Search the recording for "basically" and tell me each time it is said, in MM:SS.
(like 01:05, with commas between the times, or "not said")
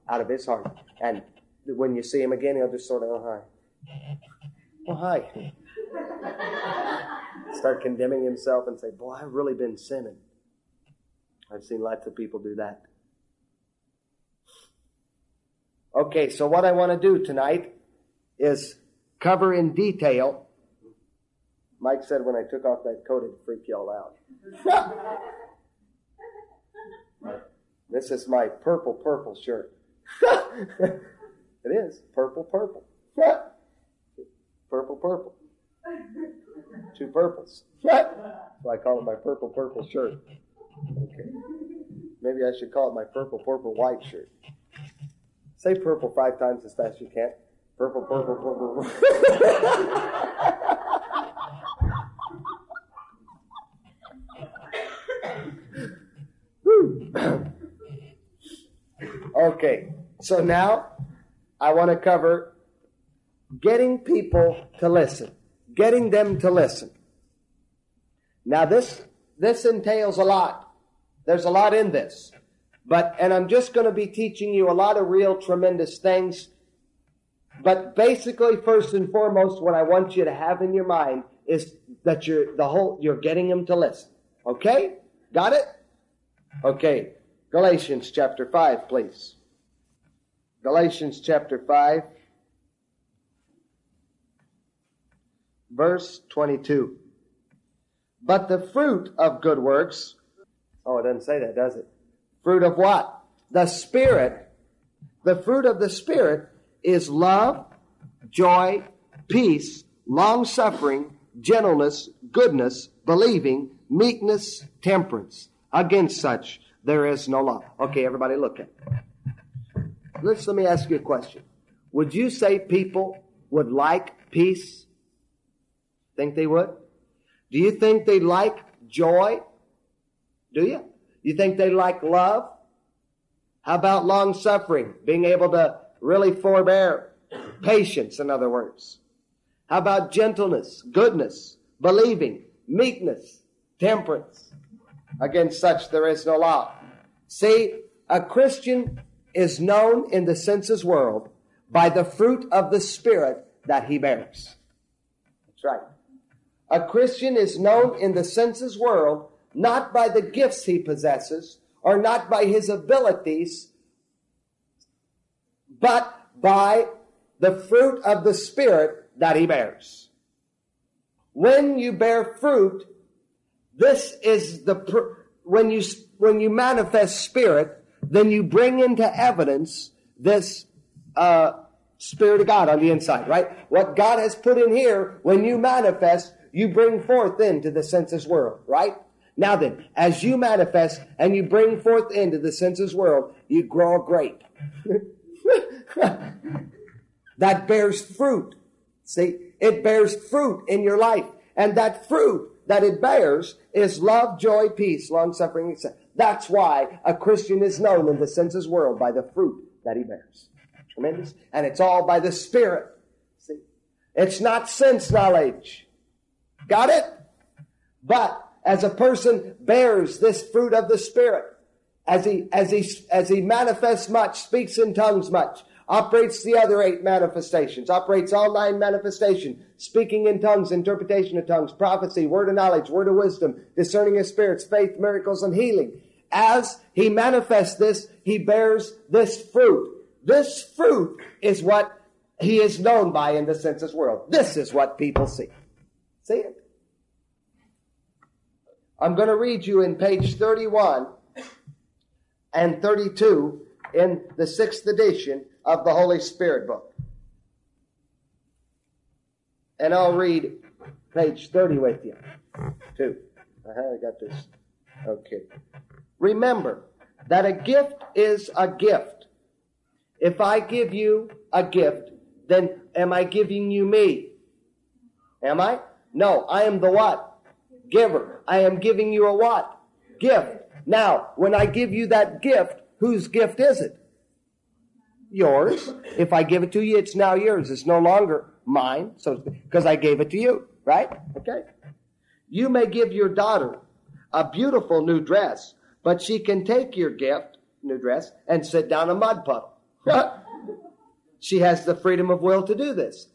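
01:17.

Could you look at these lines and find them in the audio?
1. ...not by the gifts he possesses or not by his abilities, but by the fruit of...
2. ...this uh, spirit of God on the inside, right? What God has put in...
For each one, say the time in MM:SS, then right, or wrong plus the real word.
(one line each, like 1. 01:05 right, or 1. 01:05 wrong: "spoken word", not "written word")
1. 02:39 right
2. 03:00 right.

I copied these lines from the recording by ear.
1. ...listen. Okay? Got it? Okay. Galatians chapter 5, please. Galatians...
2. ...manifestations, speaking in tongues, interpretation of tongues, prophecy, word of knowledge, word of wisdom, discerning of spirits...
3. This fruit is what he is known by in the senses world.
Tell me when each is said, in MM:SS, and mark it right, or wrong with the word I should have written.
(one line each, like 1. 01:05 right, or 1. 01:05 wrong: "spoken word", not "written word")
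1. 01:23 right
2. 03:48 right
3. 04:00 right.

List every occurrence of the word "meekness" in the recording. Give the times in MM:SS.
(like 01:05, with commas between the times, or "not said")
01:53, 02:22.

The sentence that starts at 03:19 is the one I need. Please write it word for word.
See, it bears fruit in your life, and that fruit that it bears is love, joy, peace, long suffering, etc.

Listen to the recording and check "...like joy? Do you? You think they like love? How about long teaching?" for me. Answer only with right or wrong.
wrong.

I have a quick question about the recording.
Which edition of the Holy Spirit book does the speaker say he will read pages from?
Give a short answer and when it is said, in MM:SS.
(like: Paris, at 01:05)
Sixth edition, at 04:14.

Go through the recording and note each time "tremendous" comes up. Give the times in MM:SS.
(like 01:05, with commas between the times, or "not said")
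01:15, 03:30.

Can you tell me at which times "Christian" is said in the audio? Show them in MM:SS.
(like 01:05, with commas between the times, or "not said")
02:28, 02:36, 03:27.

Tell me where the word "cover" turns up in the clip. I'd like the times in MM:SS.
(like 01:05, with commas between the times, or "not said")
00:19, 01:01.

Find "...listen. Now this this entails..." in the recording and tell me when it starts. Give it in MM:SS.
01:06.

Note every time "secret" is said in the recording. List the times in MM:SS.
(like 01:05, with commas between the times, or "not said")
not said.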